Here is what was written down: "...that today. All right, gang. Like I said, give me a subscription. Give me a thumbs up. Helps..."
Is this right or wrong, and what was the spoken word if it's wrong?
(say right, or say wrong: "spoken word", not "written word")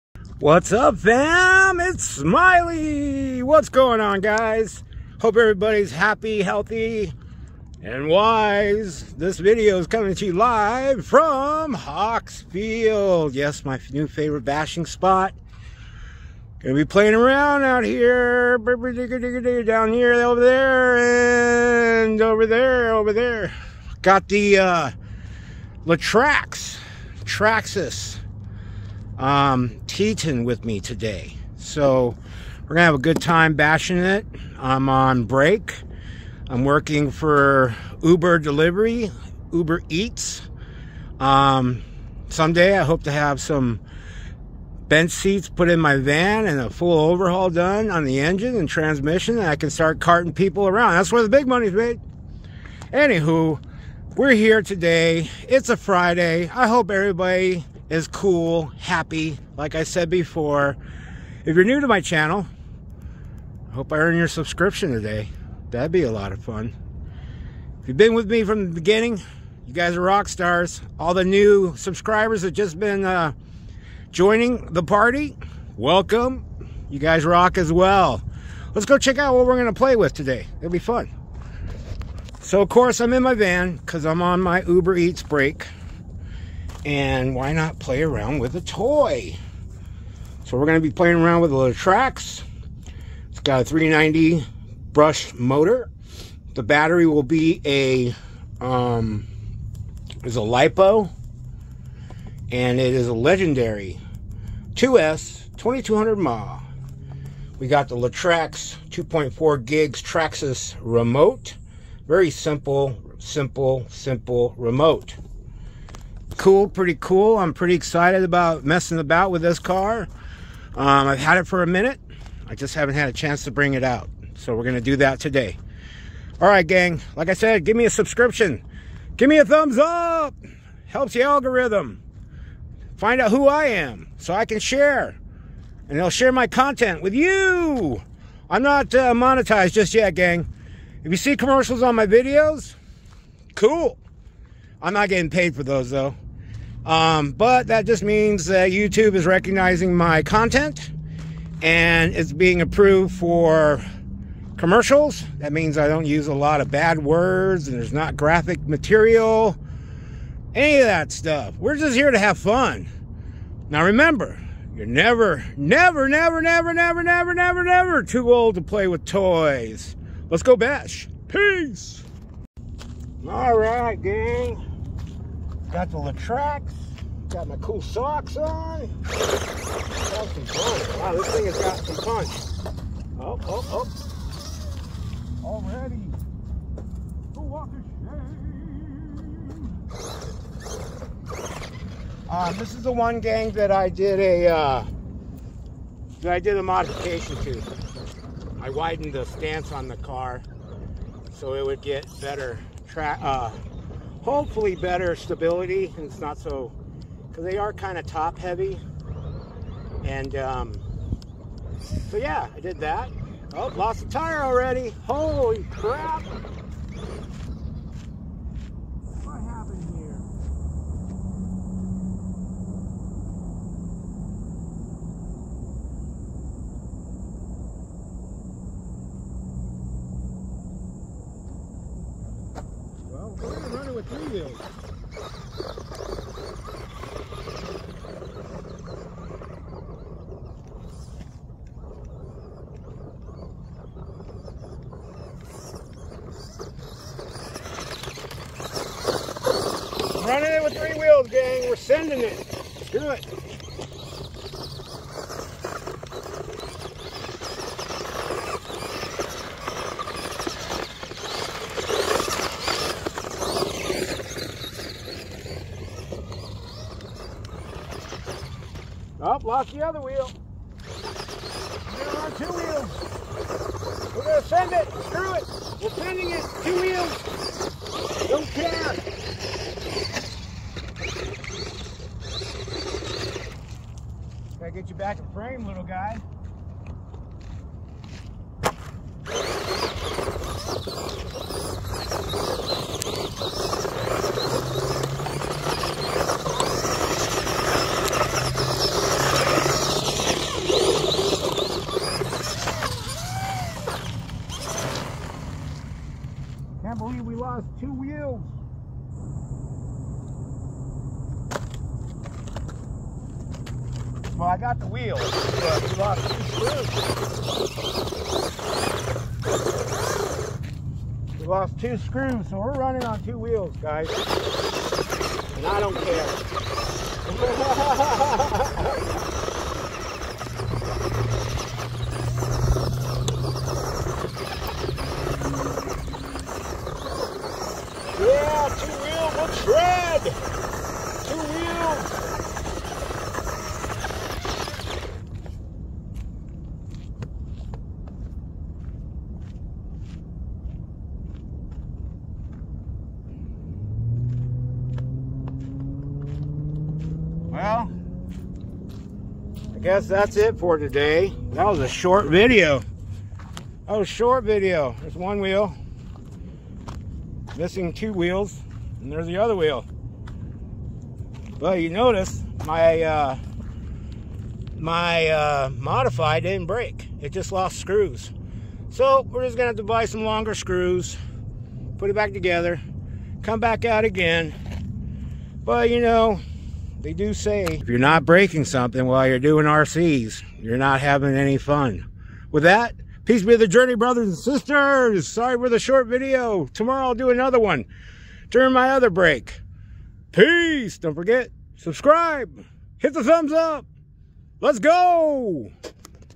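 right.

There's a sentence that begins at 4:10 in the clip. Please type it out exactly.
running it with three wheels, gang.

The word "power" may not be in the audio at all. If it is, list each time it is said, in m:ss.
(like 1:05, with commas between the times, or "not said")
not said.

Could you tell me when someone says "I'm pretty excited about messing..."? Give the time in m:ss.
1:57.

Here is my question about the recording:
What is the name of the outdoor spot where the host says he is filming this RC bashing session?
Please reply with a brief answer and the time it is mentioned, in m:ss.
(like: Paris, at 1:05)
Hawk's Field, at 0:11.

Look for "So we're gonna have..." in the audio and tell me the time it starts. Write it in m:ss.
0:31.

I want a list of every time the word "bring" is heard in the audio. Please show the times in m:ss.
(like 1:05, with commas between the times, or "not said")
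2:03.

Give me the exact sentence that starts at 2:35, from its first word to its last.
That means I don't use a lot of bad words and there's not graphic material, any of that stuff.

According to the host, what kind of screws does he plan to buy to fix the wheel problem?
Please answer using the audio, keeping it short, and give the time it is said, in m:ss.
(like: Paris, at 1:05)
longer screws, at 6:20.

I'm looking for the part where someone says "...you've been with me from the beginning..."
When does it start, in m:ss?
1:07.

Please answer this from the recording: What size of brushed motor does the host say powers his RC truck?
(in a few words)
390.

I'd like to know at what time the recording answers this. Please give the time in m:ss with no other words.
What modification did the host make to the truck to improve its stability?
3:18.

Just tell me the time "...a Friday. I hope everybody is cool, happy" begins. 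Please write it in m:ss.
0:55.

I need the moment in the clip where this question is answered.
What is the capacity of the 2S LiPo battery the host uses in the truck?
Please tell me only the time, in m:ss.
1:45.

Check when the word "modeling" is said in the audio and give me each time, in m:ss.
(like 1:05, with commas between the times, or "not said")
not said.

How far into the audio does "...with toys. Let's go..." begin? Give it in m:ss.
2:48.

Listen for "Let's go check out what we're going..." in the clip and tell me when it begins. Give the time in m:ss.
1:18.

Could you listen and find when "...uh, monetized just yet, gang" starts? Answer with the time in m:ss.
2:18.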